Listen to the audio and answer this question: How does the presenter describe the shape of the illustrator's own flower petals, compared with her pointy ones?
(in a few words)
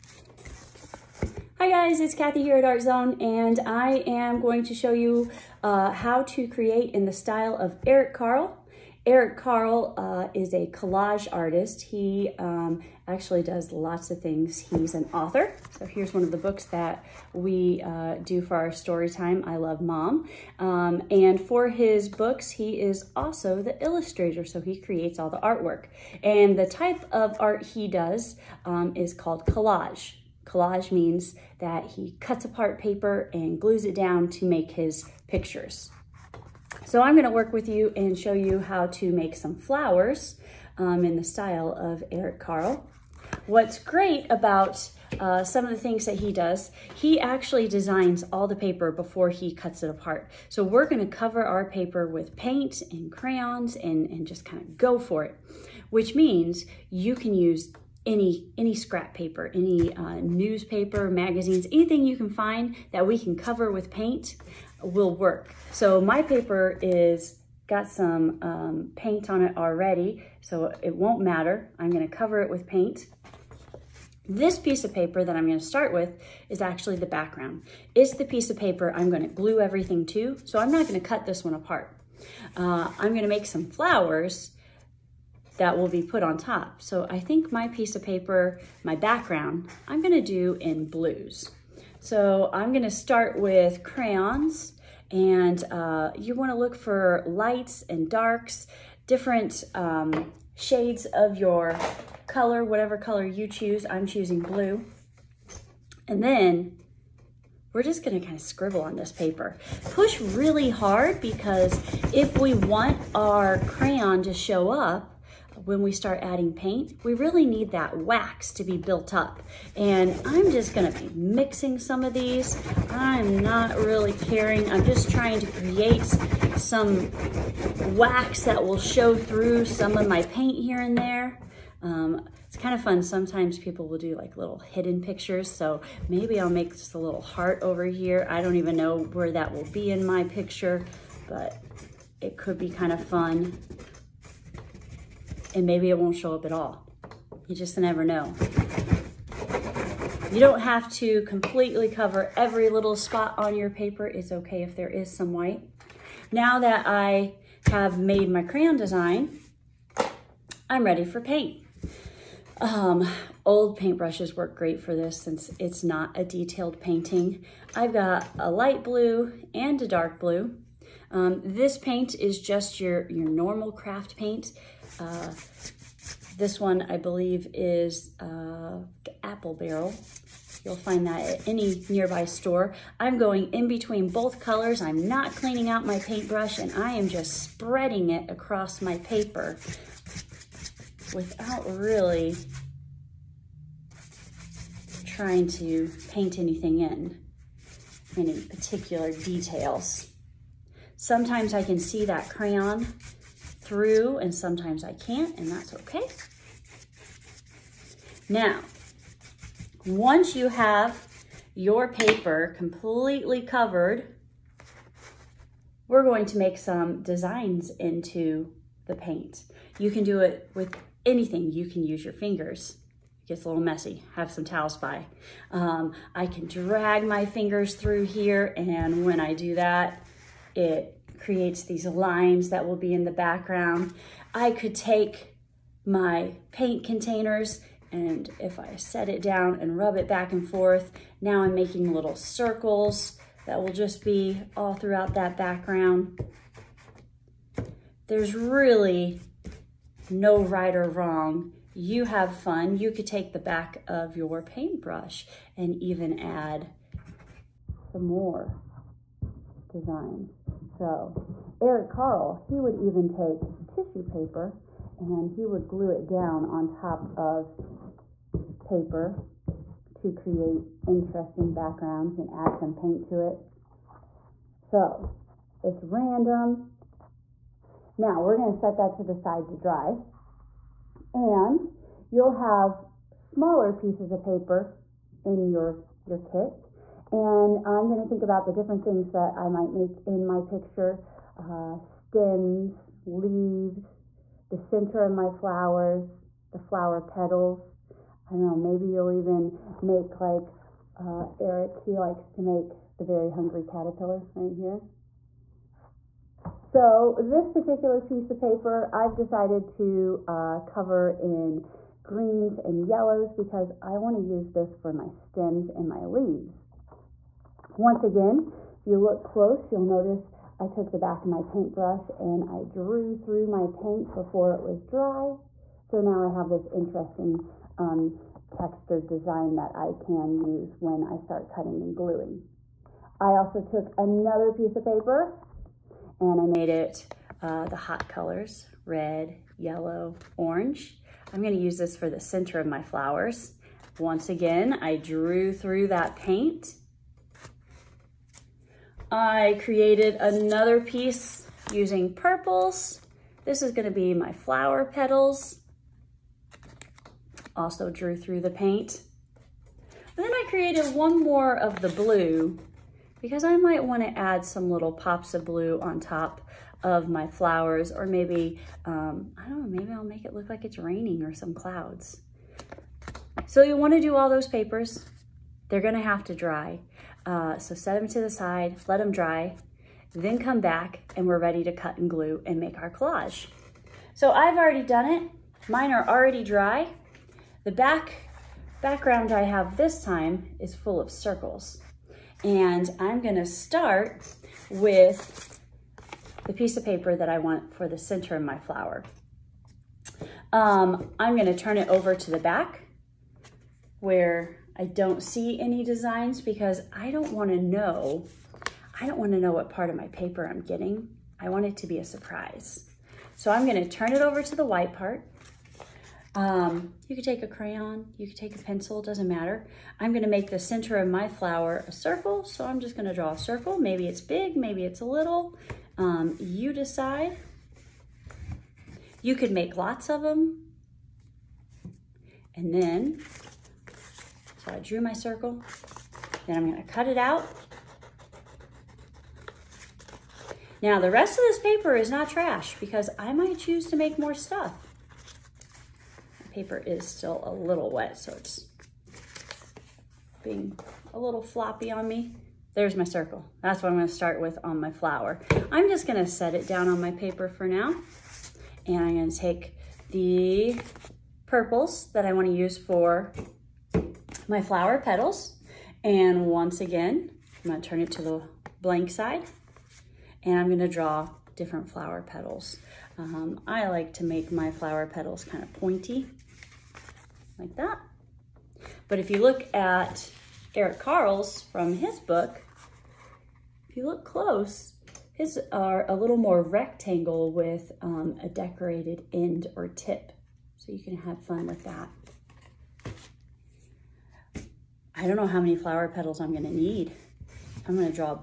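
rectangle.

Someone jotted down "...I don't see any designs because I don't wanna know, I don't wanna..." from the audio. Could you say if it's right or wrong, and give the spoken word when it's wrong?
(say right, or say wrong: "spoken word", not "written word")
right.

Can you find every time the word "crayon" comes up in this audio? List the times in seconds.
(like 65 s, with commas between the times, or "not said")
53 s, 93 s, 113 s, 158 s, 202 s, 417 s.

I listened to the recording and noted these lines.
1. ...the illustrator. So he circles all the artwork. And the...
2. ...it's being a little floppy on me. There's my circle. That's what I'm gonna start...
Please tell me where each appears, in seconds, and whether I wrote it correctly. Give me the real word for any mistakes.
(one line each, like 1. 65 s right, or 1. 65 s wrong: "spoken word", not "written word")
1. 23 s wrong: "creates", not "circles"
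2. 448 s right.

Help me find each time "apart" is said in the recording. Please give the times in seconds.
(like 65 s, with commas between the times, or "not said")
32 s, 49 s, 81 s.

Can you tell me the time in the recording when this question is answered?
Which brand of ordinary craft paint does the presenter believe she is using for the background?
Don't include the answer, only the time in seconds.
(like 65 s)
179 s.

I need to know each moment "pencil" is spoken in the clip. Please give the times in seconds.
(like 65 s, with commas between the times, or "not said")
418 s.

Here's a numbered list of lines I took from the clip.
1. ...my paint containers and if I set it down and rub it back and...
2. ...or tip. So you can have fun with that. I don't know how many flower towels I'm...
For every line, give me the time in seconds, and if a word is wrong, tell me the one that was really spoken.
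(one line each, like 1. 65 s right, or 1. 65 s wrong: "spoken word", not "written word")
1. 235 s right
2. 489 s wrong: "petals", not "towels".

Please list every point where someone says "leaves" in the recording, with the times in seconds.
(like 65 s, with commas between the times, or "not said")
293 s, 316 s.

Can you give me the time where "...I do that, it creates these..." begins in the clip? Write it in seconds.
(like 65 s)
229 s.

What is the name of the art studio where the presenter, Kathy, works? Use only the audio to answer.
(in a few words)
Art Zone.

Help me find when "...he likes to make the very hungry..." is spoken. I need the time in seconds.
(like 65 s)
301 s.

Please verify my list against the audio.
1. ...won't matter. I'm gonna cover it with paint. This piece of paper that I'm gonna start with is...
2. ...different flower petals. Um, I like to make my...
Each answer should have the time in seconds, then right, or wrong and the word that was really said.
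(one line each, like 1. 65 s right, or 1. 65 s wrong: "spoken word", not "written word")
1. 70 s right
2. 471 s right.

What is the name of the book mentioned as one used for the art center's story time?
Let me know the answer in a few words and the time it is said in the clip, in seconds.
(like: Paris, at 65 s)
I Love Mom, at 19 s.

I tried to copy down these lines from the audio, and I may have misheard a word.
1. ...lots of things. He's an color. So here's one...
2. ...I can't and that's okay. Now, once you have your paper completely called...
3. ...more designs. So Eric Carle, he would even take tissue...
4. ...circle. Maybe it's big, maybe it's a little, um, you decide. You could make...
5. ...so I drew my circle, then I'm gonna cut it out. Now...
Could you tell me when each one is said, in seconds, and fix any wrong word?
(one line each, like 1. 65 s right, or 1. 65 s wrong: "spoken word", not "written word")
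1. 13 s wrong: "author", not "color"
2. 204 s wrong: "covered", not "called"
3. 258 s right
4. 423 s right
5. 434 s right.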